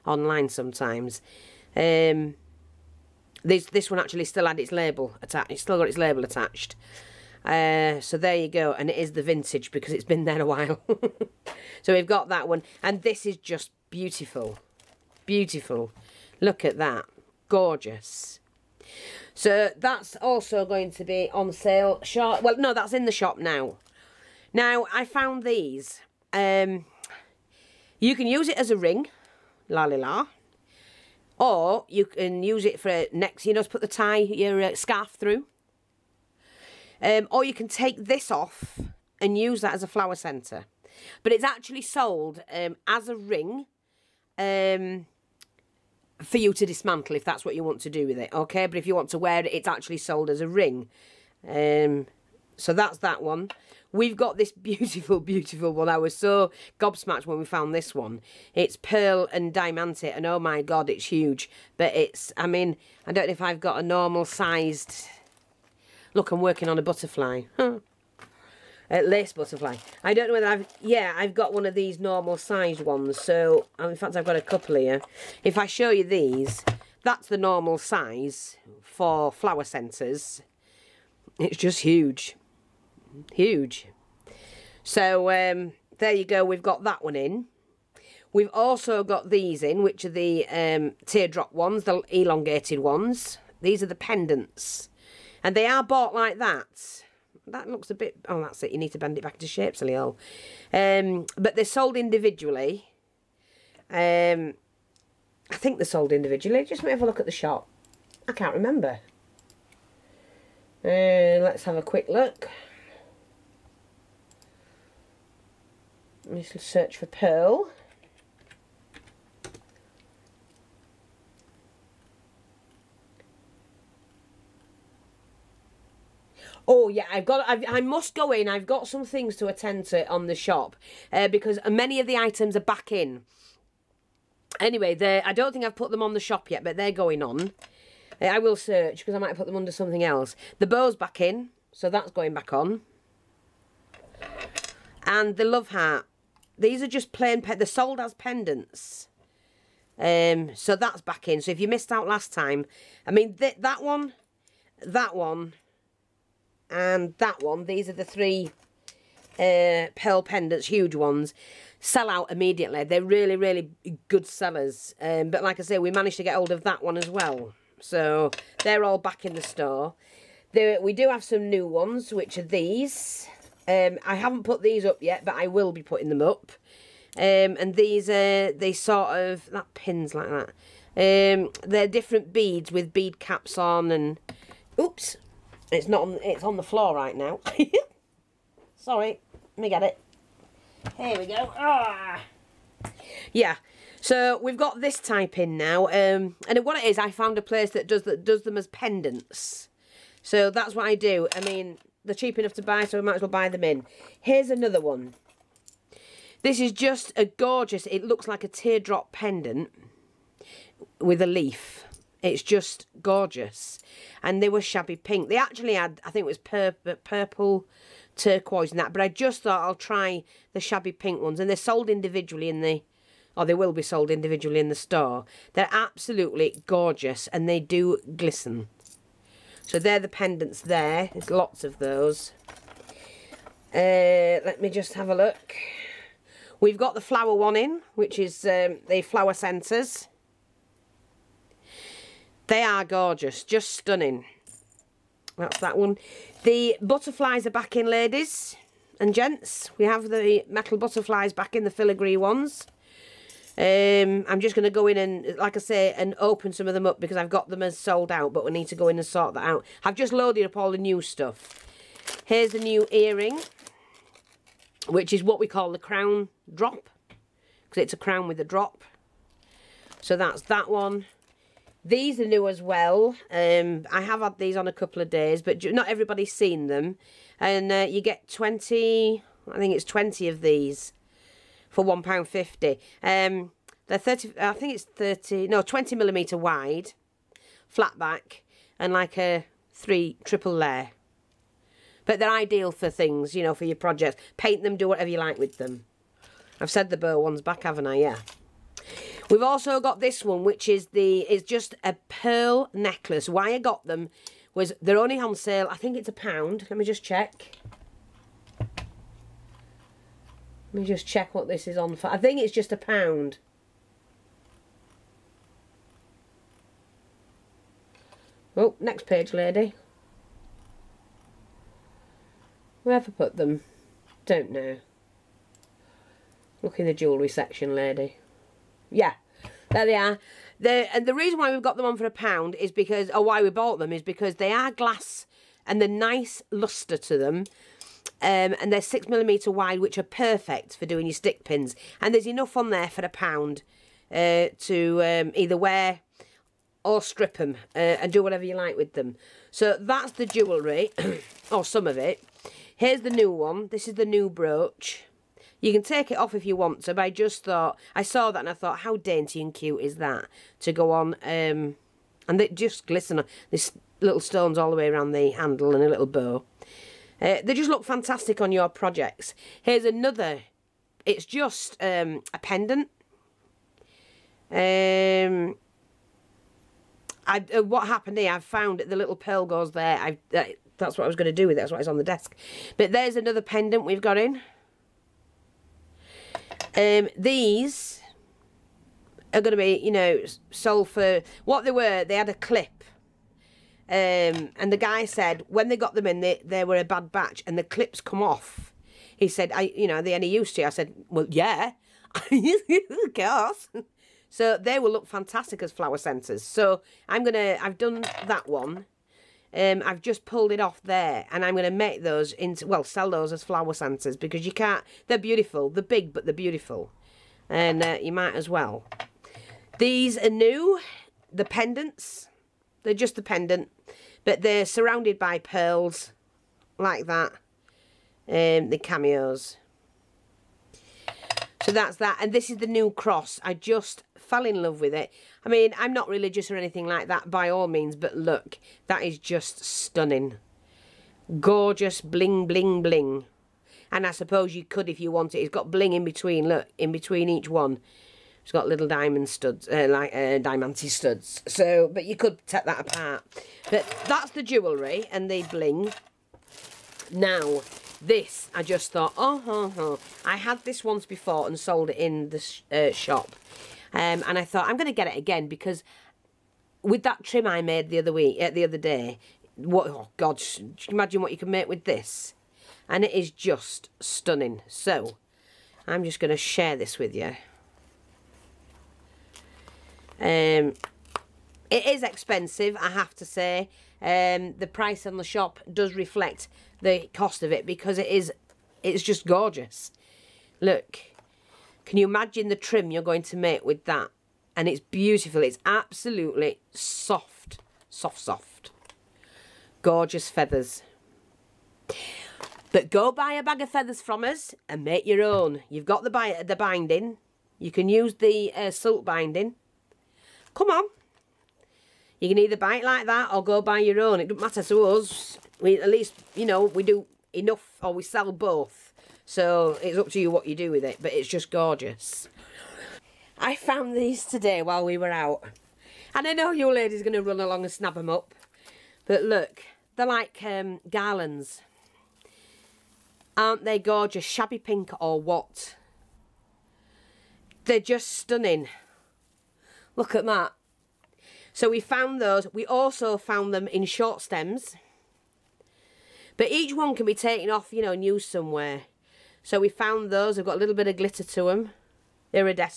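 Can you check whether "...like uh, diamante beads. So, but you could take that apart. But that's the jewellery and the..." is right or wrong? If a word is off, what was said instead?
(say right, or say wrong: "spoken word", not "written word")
wrong: "studs", not "beads".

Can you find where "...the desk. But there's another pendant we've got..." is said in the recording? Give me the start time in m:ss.
6:21.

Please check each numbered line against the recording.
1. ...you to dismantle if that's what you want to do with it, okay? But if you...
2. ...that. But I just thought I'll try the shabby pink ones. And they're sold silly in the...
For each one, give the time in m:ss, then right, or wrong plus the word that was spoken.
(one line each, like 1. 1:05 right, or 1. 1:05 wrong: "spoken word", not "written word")
1. 0:46 right
2. 3:38 wrong: "individually", not "silly".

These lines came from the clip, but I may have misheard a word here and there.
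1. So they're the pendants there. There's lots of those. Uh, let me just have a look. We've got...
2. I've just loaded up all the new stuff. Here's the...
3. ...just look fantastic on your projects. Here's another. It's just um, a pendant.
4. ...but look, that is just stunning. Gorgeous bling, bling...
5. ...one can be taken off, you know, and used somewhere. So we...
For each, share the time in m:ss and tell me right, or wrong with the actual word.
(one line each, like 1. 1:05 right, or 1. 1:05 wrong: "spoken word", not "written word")
1. 3:49 right
2. 4:19 right
3. 6:07 right
4. 7:17 right
5. 9:06 right.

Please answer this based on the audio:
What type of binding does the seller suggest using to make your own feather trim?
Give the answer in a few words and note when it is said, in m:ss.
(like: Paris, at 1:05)
silk binding, at 8:28.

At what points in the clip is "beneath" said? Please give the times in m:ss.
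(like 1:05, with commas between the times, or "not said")
not said.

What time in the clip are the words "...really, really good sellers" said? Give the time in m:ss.
2:43.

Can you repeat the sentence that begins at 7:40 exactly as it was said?
I had this once before and sold it in the sh uh, shop.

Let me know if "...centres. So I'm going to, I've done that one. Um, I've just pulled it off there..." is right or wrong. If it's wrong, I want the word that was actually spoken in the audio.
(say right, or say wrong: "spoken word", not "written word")
right.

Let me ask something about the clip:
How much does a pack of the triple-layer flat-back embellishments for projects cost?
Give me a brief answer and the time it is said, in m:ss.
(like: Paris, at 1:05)
£1.50, at 4:41.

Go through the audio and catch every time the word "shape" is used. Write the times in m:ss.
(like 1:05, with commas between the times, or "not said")
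1:39.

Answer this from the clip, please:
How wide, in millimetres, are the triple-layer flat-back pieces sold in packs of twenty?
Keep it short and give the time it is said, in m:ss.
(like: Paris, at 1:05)
20 millimetres, at 4:45.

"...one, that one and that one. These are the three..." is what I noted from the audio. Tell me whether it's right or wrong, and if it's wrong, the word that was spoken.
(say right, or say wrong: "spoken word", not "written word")
right.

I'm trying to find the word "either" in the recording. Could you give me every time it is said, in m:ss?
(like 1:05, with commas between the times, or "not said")
5:45, 8:32.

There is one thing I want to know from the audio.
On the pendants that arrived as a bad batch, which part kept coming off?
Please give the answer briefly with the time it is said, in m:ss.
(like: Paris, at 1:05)
clip, at 6:37.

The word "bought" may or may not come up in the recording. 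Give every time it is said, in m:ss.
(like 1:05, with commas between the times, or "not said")
1:35, 5:33.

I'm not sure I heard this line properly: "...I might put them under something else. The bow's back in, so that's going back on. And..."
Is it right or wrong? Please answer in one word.
right.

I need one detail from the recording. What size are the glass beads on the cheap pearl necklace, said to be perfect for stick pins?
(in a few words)
6 millimetres.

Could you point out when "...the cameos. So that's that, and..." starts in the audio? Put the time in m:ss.
7:08.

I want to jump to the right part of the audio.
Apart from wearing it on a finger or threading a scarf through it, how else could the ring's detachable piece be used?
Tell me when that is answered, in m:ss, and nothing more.
0:39.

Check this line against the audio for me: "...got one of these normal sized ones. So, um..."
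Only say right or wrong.
right.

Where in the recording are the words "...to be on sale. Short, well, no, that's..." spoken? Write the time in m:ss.
0:20.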